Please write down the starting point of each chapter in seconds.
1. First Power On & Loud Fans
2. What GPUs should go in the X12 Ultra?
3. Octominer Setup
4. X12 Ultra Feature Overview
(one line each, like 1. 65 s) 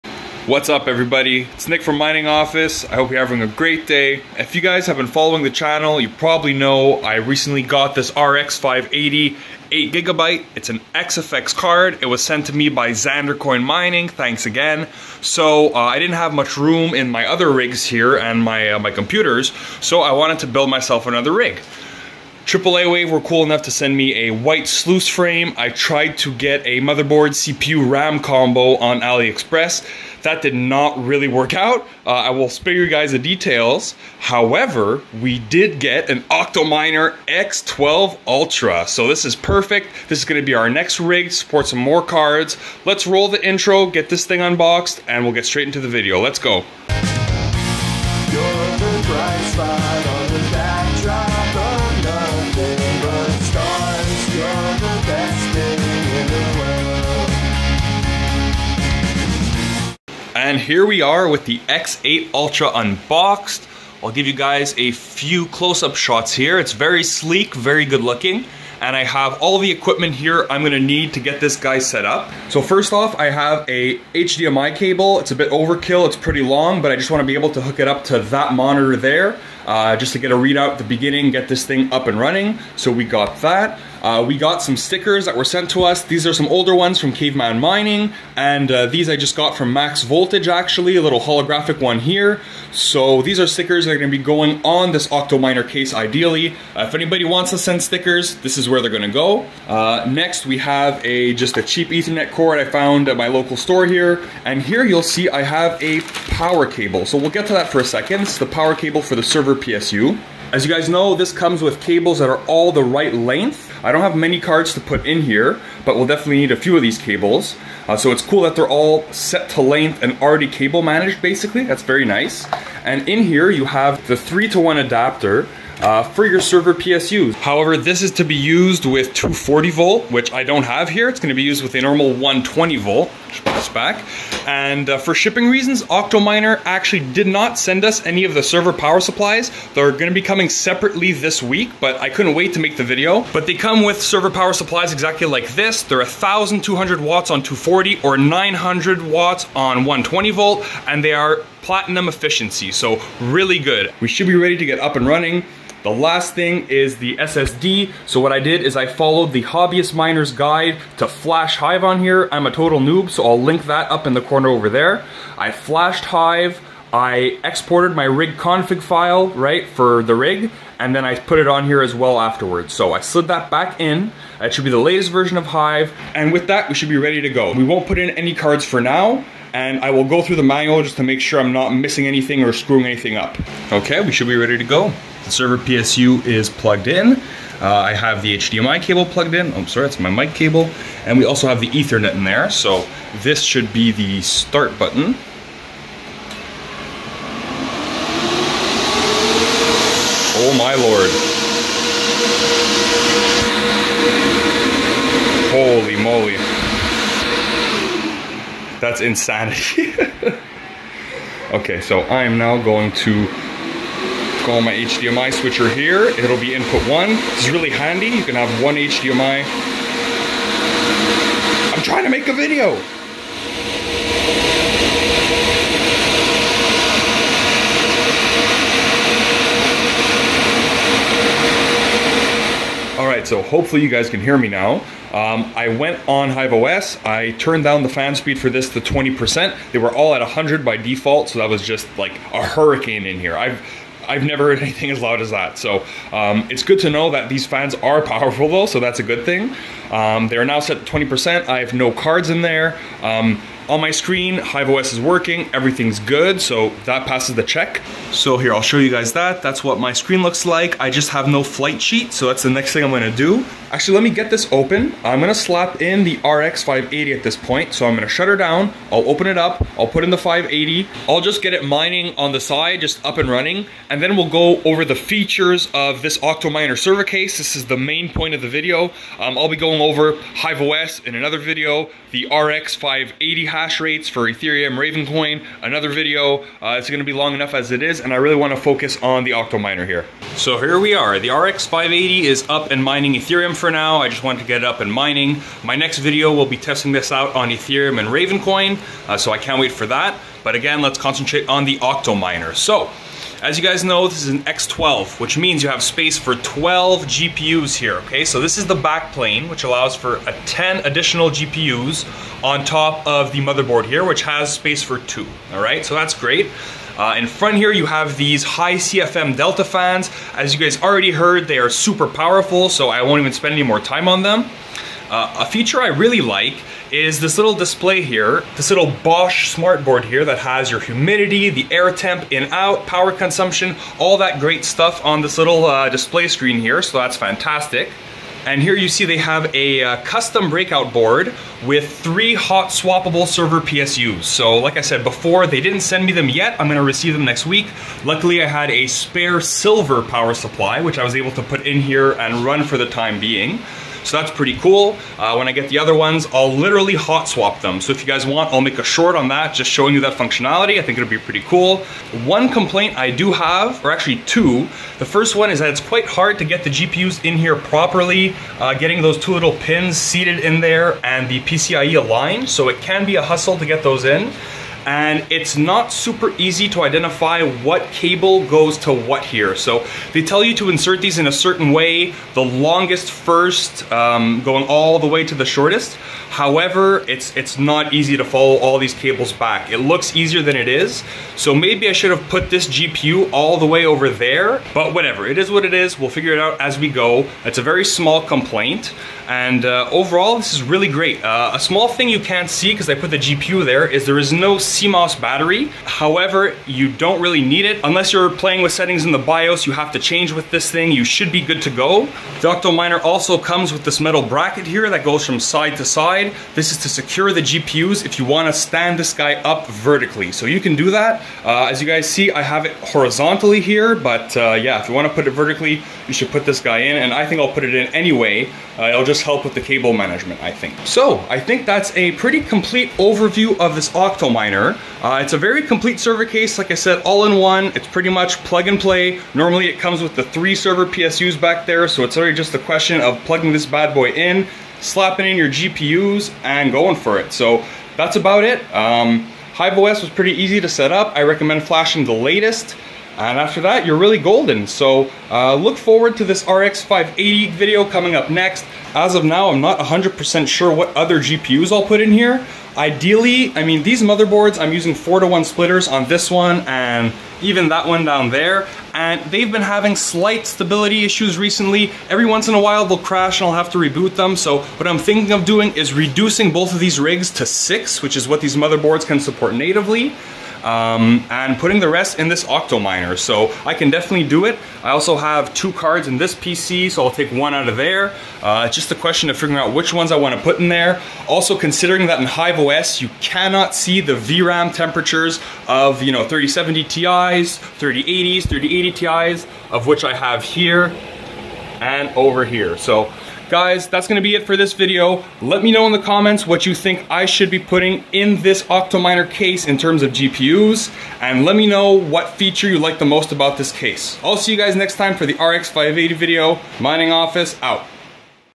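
1. 183 s
2. 455 s
3. 60 s
4. 290 s.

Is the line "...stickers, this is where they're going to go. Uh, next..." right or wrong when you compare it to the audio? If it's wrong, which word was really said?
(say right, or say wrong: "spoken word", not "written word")
right.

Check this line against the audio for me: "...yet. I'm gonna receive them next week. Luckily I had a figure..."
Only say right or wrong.
wrong.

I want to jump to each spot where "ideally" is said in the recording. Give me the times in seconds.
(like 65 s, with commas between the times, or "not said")
95 s, 462 s.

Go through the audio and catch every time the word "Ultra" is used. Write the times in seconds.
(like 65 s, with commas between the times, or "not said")
38 s, 62 s.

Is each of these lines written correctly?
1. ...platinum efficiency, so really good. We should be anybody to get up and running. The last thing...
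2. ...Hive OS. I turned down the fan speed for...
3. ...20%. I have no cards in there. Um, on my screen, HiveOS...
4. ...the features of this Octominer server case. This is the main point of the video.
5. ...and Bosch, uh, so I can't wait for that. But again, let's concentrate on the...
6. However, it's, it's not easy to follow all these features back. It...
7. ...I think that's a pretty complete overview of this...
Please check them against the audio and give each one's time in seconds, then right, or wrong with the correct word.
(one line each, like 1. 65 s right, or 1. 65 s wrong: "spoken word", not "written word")
1. 151 s wrong: "ready", not "anybody"
2. 236 s right
3. 250 s right
4. 274 s right
5. 297 s wrong: "Ravencoin", not "Bosch"
6. 386 s wrong: "cables", not "features"
7. 431 s right.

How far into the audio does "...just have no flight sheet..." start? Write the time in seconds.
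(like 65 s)
260 s.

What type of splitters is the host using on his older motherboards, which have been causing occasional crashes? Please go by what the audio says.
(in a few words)
4 to 1 splitters.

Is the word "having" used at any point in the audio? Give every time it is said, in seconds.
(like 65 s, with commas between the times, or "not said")
3 s, 469 s.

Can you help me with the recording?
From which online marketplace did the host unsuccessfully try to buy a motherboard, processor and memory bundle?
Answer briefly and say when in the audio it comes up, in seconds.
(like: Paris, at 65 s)
AliExpress, at 29 s.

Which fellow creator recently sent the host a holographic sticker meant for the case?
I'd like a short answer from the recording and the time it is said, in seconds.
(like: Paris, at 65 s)
Max Voltage, at 89 s.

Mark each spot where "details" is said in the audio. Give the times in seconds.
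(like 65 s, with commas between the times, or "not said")
33 s.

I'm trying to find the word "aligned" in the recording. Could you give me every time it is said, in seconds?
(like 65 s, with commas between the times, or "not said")
372 s.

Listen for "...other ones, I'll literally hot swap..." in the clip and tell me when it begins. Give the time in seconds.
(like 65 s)
355 s.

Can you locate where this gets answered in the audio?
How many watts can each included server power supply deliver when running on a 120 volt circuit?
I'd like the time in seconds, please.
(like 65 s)
148 s.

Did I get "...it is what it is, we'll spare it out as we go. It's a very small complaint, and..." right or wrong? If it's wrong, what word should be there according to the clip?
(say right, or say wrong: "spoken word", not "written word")
wrong: "figure", not "spare".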